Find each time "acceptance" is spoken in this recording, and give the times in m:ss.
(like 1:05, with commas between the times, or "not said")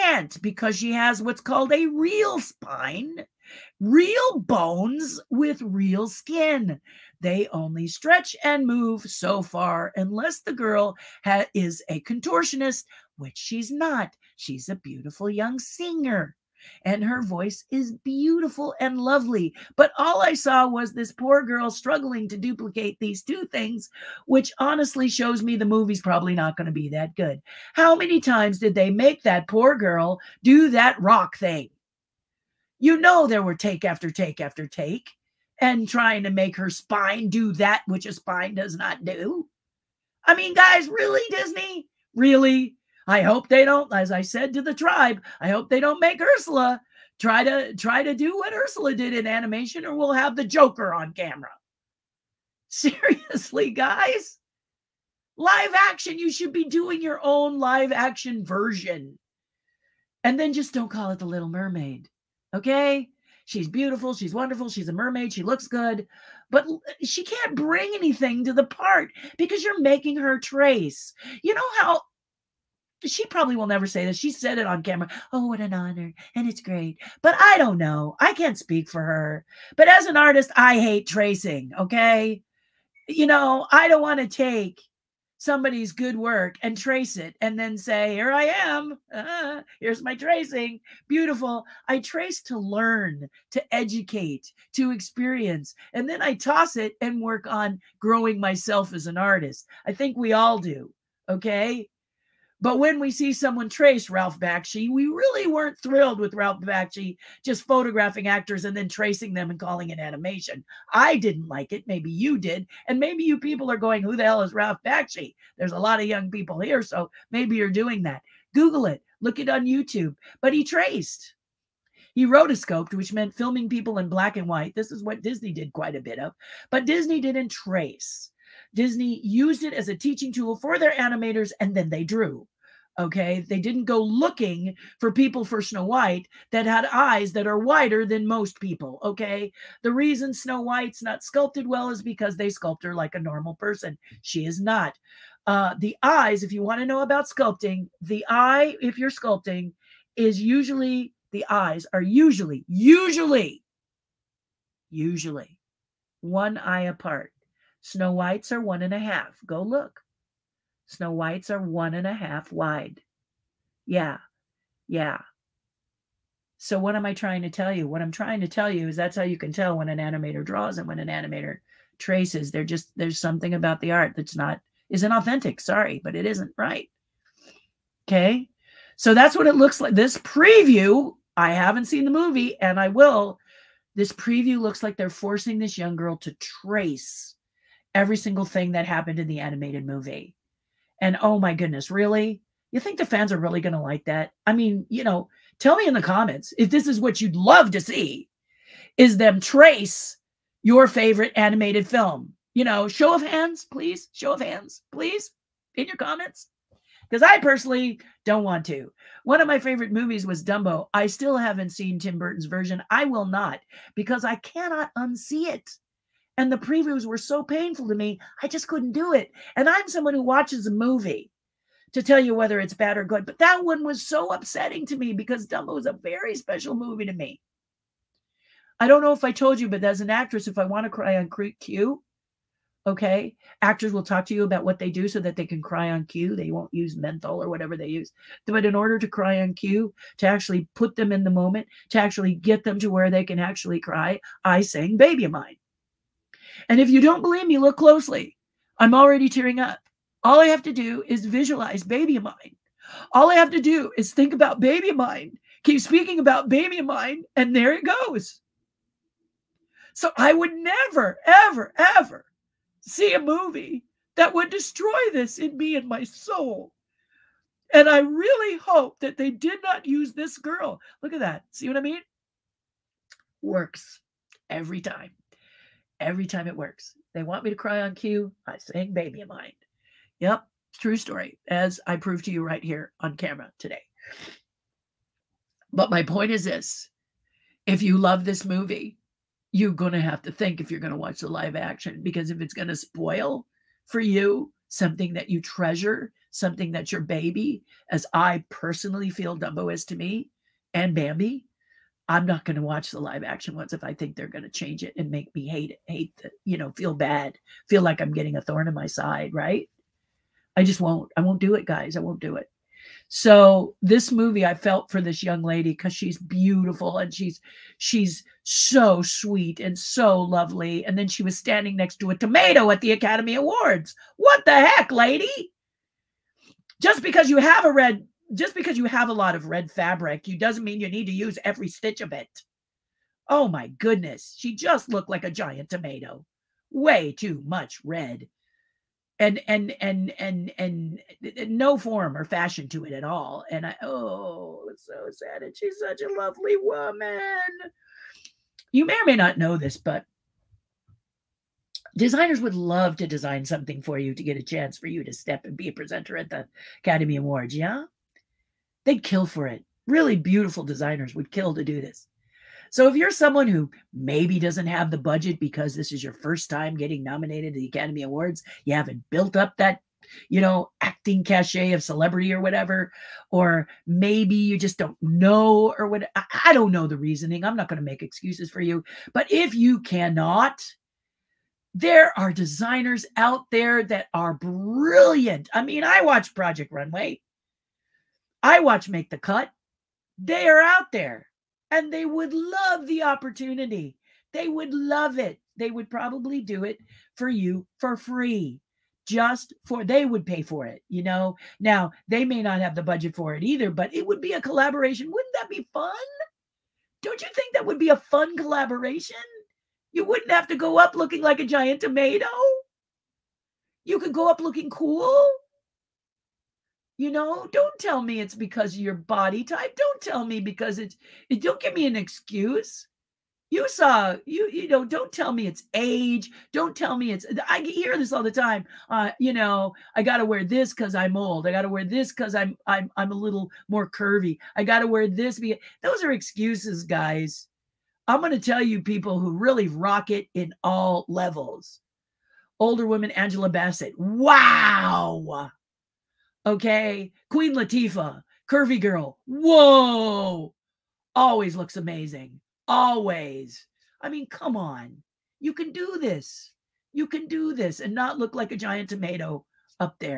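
not said.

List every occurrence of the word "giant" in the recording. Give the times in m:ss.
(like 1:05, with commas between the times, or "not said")
5:35, 6:51, 7:38.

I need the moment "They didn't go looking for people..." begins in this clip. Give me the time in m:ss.
2:13.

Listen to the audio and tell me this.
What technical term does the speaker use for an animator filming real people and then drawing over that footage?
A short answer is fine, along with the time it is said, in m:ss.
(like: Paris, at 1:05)
rotoscoped, at 2:02.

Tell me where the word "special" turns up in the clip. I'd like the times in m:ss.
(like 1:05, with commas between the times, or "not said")
3:46.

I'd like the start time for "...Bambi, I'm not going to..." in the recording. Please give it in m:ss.
5:00.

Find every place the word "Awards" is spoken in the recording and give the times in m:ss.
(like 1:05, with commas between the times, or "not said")
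5:23, 5:57, 6:08.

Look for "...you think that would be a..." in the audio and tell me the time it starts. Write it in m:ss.
6:47.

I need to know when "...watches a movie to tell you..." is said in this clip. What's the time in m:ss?
3:40.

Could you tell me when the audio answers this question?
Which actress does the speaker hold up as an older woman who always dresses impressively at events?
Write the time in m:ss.
7:23.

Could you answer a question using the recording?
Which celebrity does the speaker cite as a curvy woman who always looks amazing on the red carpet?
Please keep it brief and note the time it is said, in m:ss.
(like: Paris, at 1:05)
Queen Latifah, at 7:27.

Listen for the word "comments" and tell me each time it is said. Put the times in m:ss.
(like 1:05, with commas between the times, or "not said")
3:16, 3:25.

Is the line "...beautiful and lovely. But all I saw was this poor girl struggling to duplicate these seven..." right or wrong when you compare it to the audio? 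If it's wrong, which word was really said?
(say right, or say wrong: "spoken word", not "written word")
wrong: "two", not "seven".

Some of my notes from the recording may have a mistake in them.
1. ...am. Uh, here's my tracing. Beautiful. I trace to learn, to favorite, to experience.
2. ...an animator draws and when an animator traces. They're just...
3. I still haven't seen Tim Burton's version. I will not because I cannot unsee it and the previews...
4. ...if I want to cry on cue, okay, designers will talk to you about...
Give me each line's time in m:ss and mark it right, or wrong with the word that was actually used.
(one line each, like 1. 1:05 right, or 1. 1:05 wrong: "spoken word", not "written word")
1. 1:28 wrong: "educate", not "favorite"
2. 2:49 right
3. 3:30 right
4. 3:50 wrong: "actors", not "designers".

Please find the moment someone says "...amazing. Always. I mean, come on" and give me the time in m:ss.
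7:31.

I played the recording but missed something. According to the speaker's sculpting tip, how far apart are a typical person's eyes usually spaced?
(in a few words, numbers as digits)
one eye apart.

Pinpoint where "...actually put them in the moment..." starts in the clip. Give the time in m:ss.
4:00.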